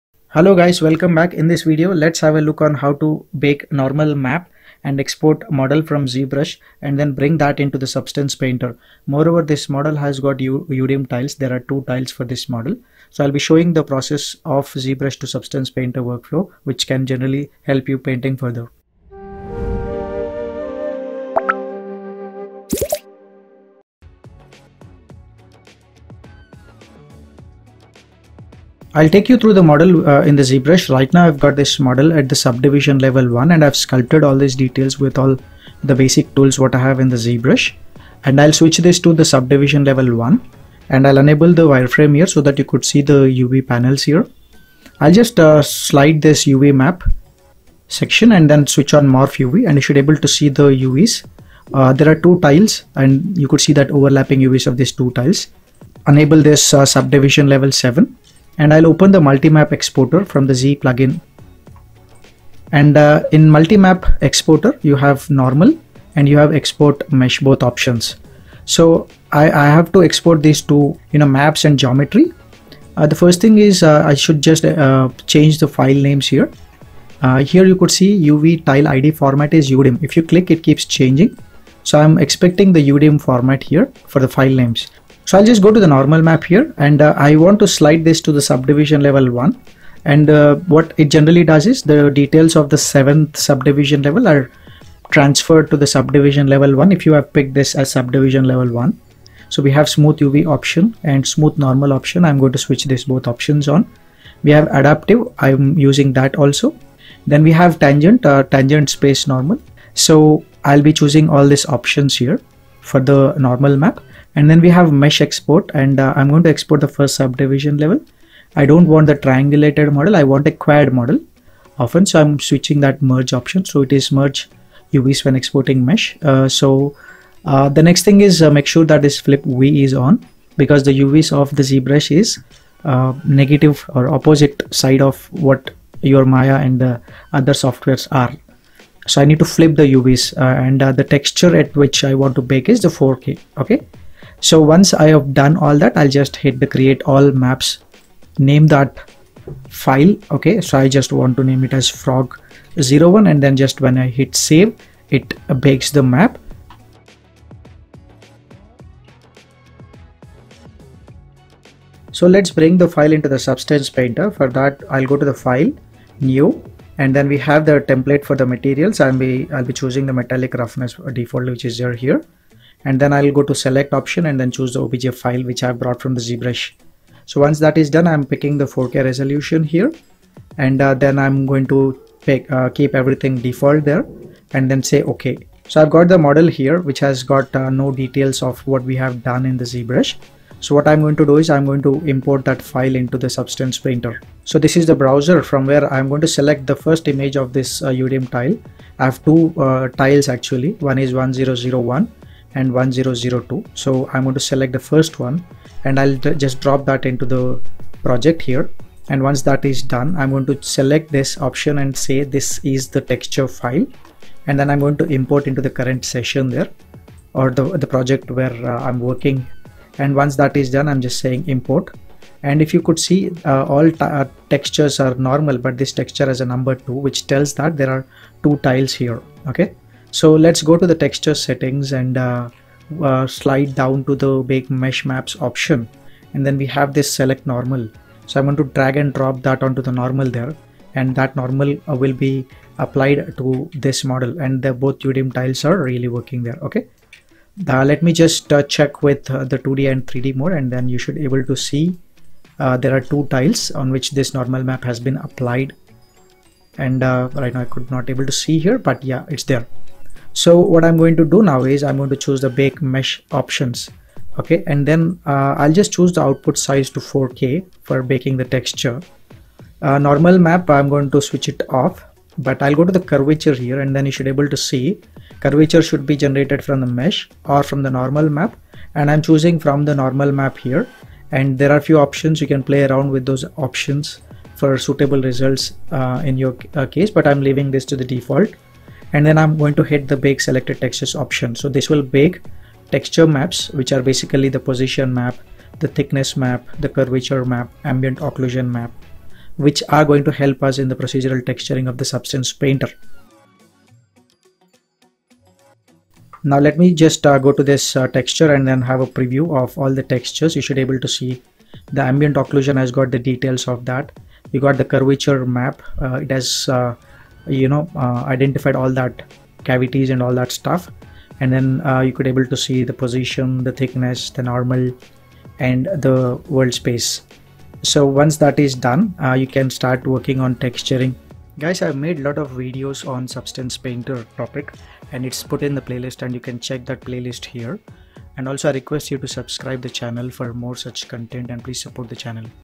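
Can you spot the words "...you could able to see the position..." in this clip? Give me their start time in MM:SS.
05:22.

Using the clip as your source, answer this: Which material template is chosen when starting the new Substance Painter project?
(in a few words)
Metallic roughness default.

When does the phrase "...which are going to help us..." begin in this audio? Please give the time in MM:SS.
04:59.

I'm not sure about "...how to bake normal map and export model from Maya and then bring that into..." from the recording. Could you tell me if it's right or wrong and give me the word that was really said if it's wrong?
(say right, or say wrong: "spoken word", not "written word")
wrong: "ZBrush", not "Maya".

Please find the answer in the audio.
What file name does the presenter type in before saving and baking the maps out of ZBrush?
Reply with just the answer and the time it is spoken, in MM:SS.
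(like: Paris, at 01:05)
frog01, at 02:31.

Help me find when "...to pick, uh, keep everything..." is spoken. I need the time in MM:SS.
03:01.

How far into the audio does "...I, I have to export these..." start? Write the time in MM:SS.
01:09.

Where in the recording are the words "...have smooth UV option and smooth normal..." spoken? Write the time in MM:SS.
01:39.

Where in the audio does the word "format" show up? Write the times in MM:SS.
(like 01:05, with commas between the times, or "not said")
01:19, 01:23.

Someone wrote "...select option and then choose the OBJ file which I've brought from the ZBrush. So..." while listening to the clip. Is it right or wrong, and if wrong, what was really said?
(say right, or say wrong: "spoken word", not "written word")
right.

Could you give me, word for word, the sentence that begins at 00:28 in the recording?
I'll take you through the model uh, in the ZBrush.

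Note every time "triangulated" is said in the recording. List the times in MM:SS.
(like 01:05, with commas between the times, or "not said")
01:59.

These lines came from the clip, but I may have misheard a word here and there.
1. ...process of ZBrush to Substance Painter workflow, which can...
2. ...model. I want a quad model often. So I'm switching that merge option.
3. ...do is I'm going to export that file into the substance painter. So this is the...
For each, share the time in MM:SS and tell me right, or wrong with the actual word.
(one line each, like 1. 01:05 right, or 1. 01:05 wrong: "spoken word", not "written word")
1. 00:13 right
2. 01:59 right
3. 03:11 wrong: "import", not "export".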